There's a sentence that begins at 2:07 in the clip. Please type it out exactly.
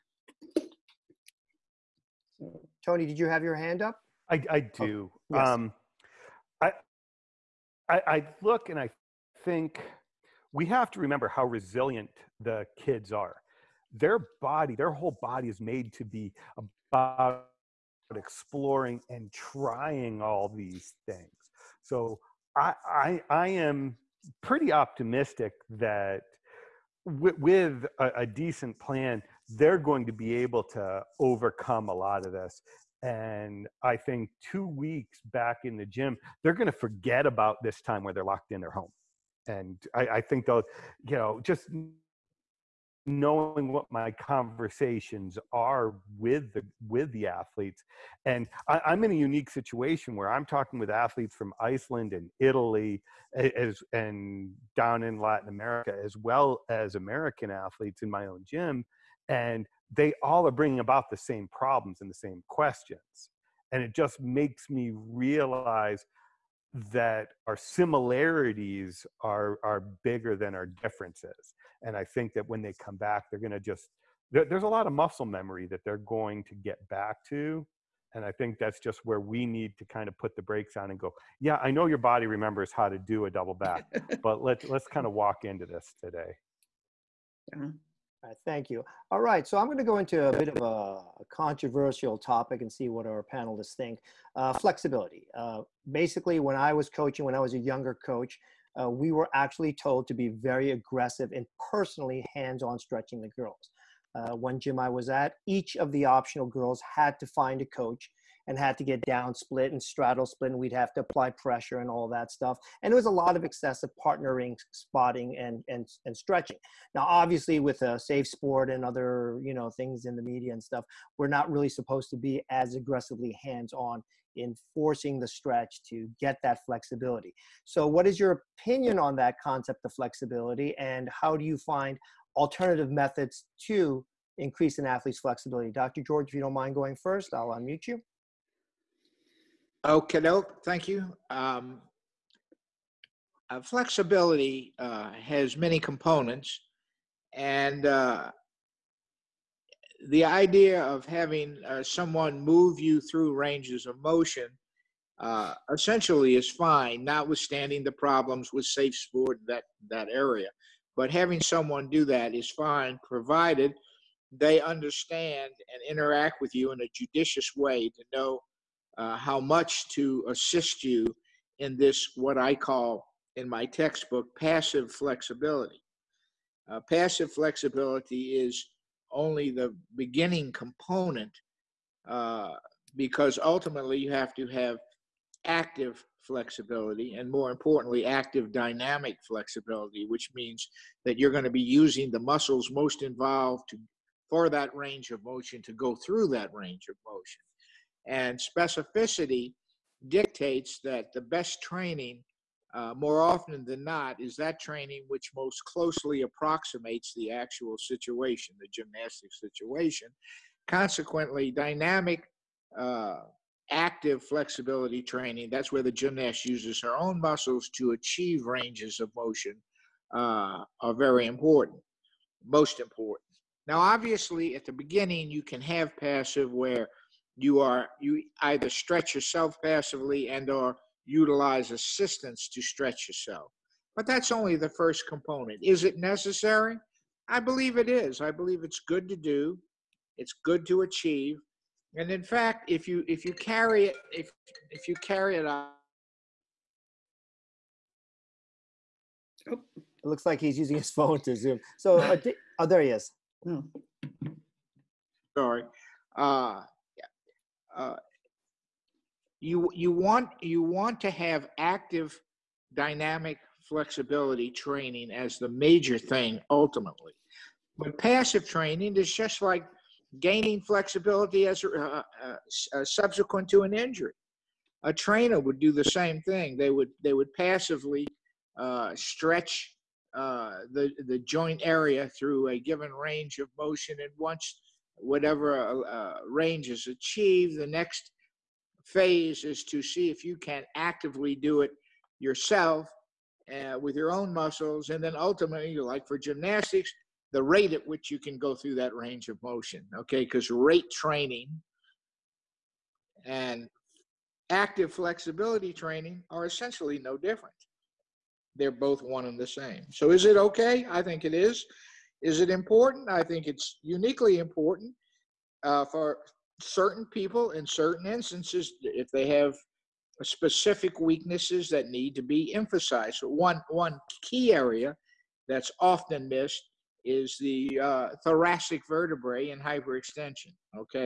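So, what is your opinion on that concept of flexibility, and how do you find alternative methods to increase an athlete's flexibility?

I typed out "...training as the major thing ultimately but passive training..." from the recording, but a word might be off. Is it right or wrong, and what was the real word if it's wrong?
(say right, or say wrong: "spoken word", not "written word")
right.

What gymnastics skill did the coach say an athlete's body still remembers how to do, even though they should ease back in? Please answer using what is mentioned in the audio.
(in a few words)
double back.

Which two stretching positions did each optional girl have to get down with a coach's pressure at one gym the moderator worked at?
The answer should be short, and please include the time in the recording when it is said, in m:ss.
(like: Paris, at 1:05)
split and straddle split, at 1:49.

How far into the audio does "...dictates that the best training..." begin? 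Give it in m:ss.
3:20.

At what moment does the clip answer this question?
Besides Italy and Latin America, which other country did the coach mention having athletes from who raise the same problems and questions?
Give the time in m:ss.
0:51.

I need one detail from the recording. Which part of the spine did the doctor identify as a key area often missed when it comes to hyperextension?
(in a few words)
thoracic vertebrae.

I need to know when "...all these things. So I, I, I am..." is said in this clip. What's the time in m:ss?
0:20.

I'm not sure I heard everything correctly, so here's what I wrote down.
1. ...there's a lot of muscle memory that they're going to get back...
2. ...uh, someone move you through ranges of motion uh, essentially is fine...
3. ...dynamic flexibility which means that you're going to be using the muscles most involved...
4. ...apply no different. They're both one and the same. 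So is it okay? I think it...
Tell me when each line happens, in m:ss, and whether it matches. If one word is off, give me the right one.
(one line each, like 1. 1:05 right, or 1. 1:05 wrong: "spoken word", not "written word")
1. 1:14 right
2. 2:31 right
3. 3:08 right
4. 5:06 wrong: "essentially", not "apply".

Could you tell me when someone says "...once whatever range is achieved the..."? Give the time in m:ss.
4:44.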